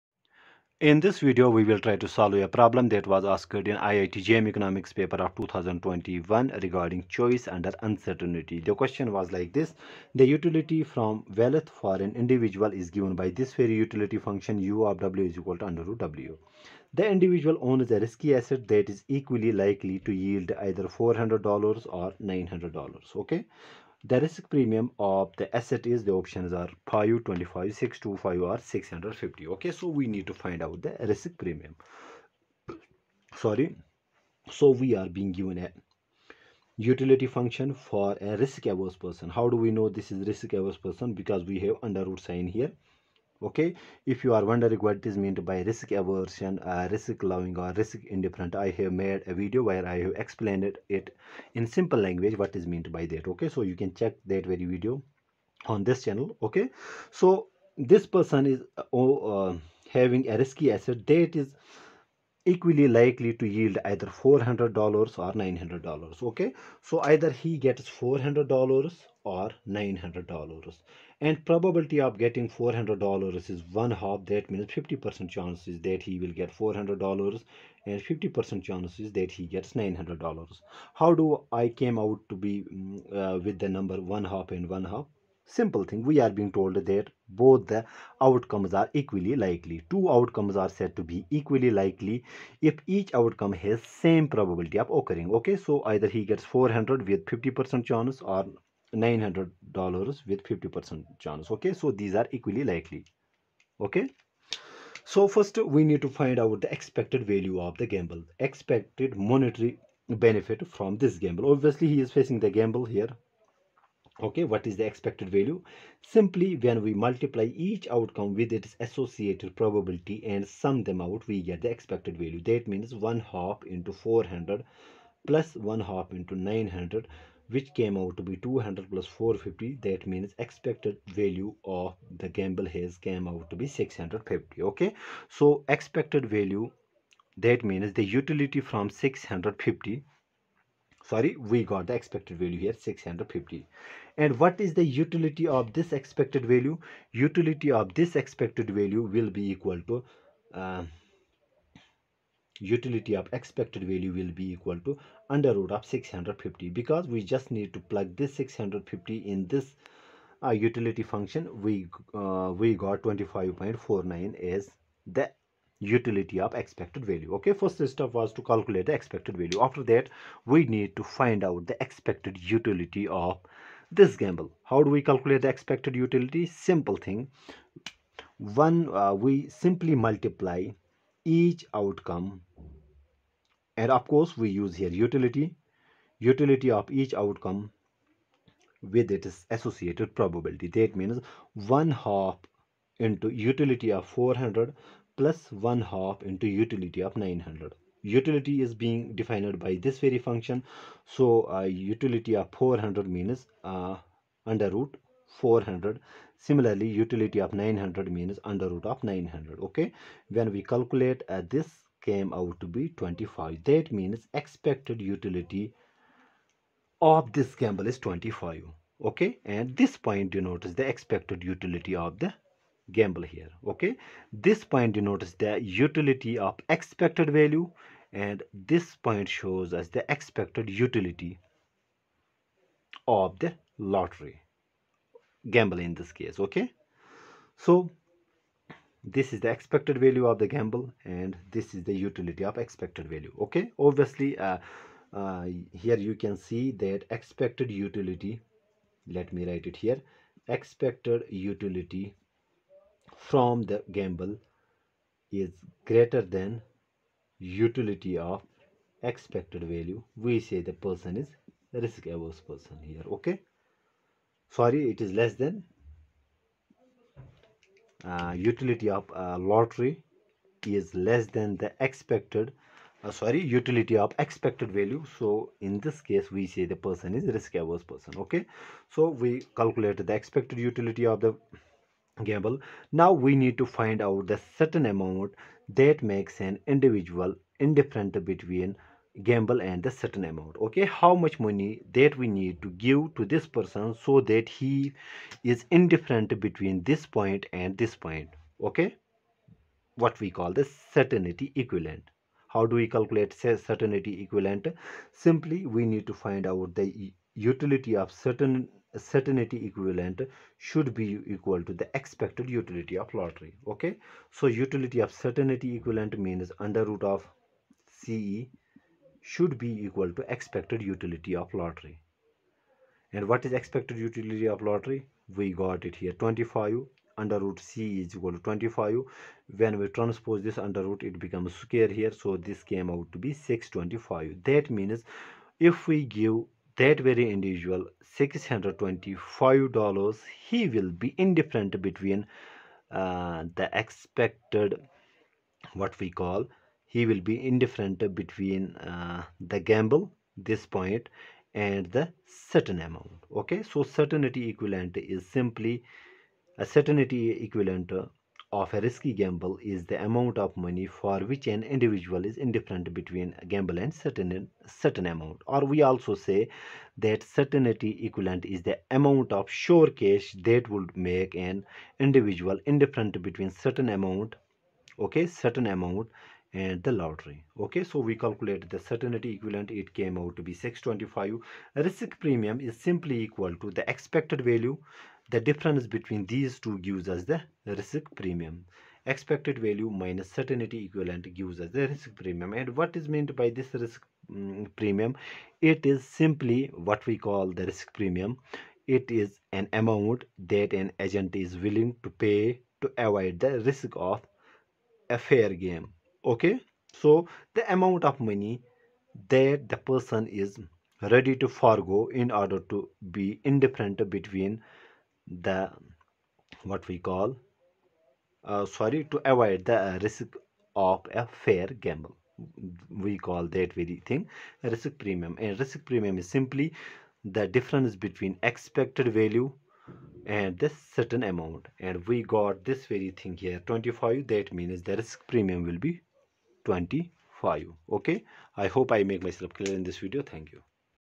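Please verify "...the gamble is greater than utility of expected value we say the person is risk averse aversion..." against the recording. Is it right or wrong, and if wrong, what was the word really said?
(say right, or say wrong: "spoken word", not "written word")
wrong: "person", not "aversion".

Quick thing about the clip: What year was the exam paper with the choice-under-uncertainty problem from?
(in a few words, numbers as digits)
2021.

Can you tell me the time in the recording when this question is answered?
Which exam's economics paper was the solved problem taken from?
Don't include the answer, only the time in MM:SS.
00:03.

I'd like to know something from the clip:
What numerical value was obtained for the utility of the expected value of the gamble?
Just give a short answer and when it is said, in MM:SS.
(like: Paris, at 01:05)
25.49, at 02:43.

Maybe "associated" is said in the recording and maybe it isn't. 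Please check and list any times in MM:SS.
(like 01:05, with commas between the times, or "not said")
01:58, 03:09.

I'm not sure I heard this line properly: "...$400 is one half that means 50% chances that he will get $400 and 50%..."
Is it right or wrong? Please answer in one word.
right.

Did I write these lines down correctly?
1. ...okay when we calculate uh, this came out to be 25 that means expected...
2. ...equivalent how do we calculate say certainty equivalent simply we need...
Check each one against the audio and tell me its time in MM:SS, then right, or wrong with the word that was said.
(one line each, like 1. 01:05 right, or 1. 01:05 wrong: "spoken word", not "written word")
1. 03:29 right
2. 05:01 right.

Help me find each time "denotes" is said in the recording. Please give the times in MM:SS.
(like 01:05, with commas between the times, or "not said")
03:40, 03:44.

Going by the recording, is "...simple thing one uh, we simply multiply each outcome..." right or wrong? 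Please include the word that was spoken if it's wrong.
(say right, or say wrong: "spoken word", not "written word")
right.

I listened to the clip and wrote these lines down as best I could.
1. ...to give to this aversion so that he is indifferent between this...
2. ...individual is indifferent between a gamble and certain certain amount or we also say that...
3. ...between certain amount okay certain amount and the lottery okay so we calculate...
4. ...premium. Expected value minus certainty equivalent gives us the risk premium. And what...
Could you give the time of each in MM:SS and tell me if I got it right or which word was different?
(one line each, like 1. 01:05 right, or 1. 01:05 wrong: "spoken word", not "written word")
1. 04:52 wrong: "person", not "aversion"
2. 06:01 right
3. 06:13 right
4. 06:28 right.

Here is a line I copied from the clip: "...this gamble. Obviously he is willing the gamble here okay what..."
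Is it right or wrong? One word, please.
wrong.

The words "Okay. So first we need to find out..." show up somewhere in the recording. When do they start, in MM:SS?
01:43.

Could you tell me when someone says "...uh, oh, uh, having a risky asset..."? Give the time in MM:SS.
00:58.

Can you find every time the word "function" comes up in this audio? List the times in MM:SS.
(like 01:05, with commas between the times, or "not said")
00:14, 00:37, 02:41, 03:20.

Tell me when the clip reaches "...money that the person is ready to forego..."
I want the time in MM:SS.
06:48.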